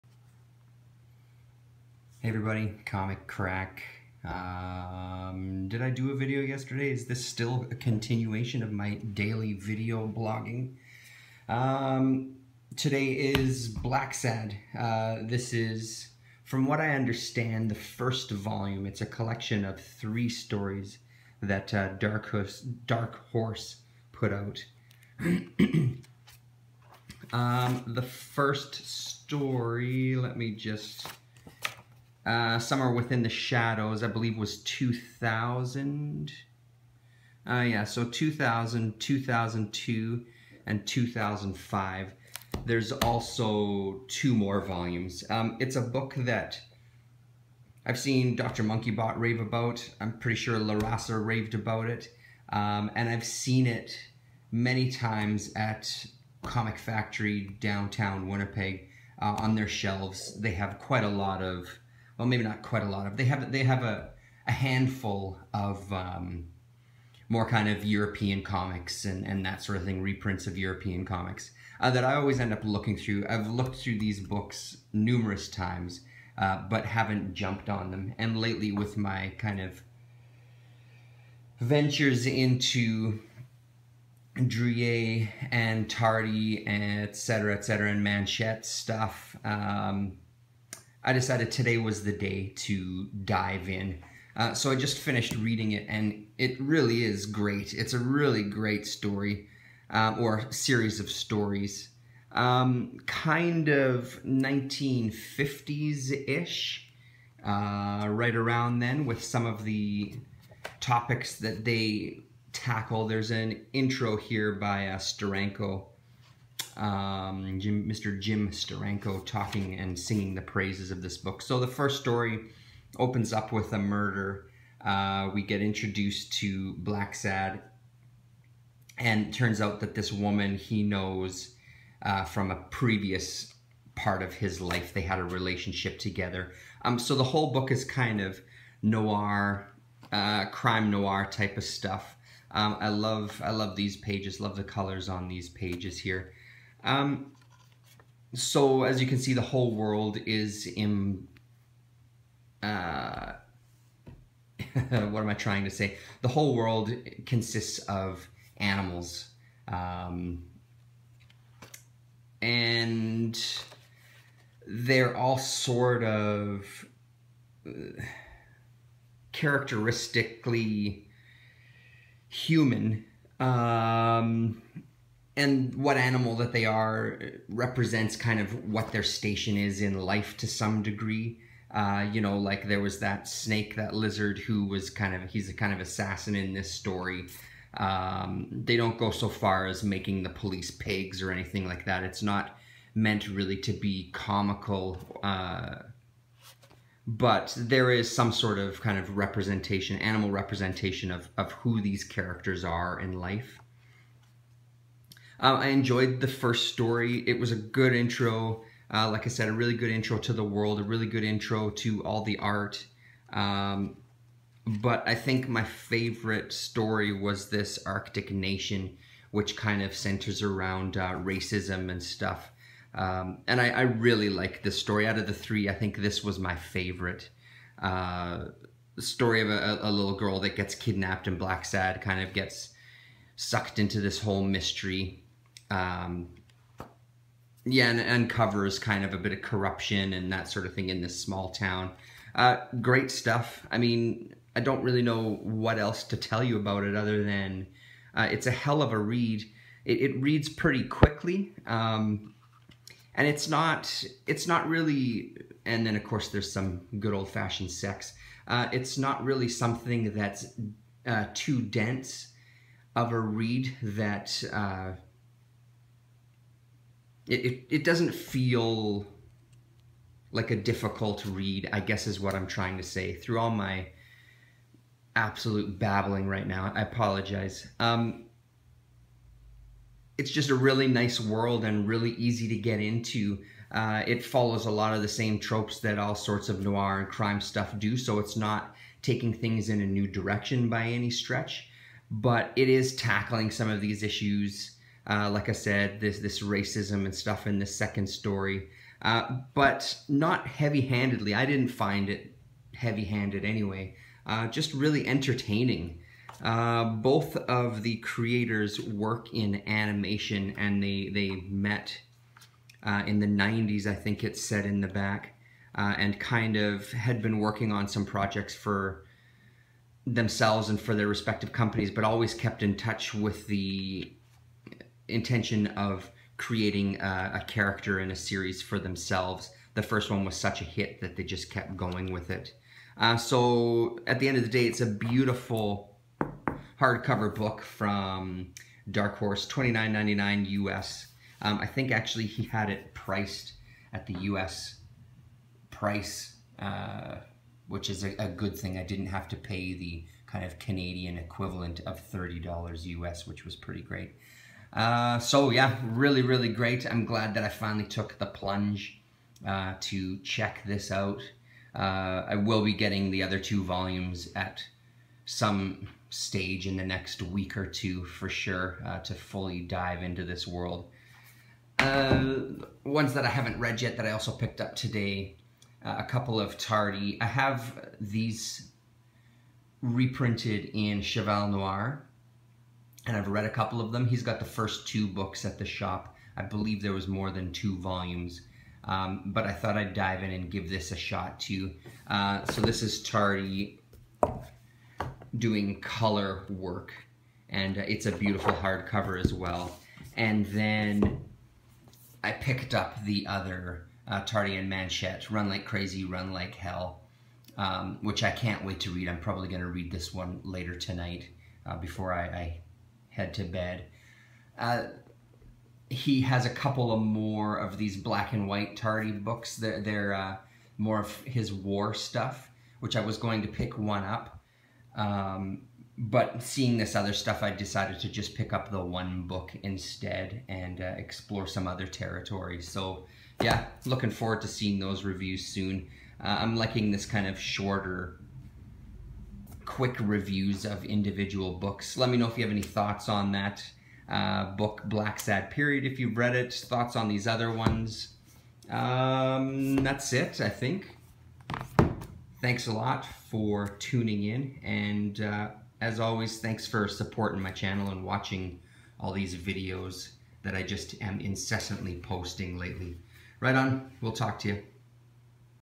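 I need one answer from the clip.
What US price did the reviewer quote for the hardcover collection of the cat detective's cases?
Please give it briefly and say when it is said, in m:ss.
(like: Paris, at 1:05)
$29.99, at 5:39.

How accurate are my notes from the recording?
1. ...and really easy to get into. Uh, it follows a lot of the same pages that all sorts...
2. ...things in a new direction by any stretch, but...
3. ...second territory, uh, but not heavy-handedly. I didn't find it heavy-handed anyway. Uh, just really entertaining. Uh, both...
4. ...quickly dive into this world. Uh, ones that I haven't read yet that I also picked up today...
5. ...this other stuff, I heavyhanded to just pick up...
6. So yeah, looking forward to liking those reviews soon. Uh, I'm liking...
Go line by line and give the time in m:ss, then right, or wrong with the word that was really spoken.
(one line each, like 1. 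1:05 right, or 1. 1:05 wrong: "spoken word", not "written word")
1. 4:41 wrong: "tropes", not "pages"
2. 4:49 right
3. 4:57 wrong: "story", not "territory"
4. 6:09 wrong: "fully", not "quickly"
5. 7:06 wrong: "decided", not "heavyhanded"
6. 7:12 wrong: "seeing", not "liking".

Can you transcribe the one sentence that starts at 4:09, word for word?
It, it reads pretty quickly, um, and it's not it's not really.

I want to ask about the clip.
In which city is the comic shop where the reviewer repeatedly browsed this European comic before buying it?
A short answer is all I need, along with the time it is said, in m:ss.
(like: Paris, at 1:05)
Winnipeg, at 0:58.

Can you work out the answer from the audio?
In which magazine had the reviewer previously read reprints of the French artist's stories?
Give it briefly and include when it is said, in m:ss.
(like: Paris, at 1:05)
Cheval Noir, at 6:21.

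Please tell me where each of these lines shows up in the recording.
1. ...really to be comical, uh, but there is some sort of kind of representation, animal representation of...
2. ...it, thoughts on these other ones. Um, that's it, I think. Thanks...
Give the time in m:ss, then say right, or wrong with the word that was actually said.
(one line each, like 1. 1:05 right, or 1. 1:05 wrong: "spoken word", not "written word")
1. 3:13 right
2. 7:26 right.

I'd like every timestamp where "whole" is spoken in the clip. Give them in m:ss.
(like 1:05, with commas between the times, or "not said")
2:17, 2:29, 2:36, 3:54.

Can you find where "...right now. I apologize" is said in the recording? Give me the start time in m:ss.
4:36.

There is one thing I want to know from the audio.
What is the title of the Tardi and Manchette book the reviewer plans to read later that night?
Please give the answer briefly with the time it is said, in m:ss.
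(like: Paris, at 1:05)
Run Like Crazy, Run Like Hell, at 6:45.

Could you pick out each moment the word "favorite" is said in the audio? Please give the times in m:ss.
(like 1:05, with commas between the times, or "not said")
3:35, 3:46.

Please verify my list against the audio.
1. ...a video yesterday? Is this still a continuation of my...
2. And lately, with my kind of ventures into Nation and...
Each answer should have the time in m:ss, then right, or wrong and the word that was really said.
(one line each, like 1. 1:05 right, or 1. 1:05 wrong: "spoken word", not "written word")
1. 0:06 right
2. 1:18 wrong: "Drouet", not "Nation".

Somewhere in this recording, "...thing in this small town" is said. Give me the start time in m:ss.
4:00.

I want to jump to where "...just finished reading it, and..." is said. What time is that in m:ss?
1:34.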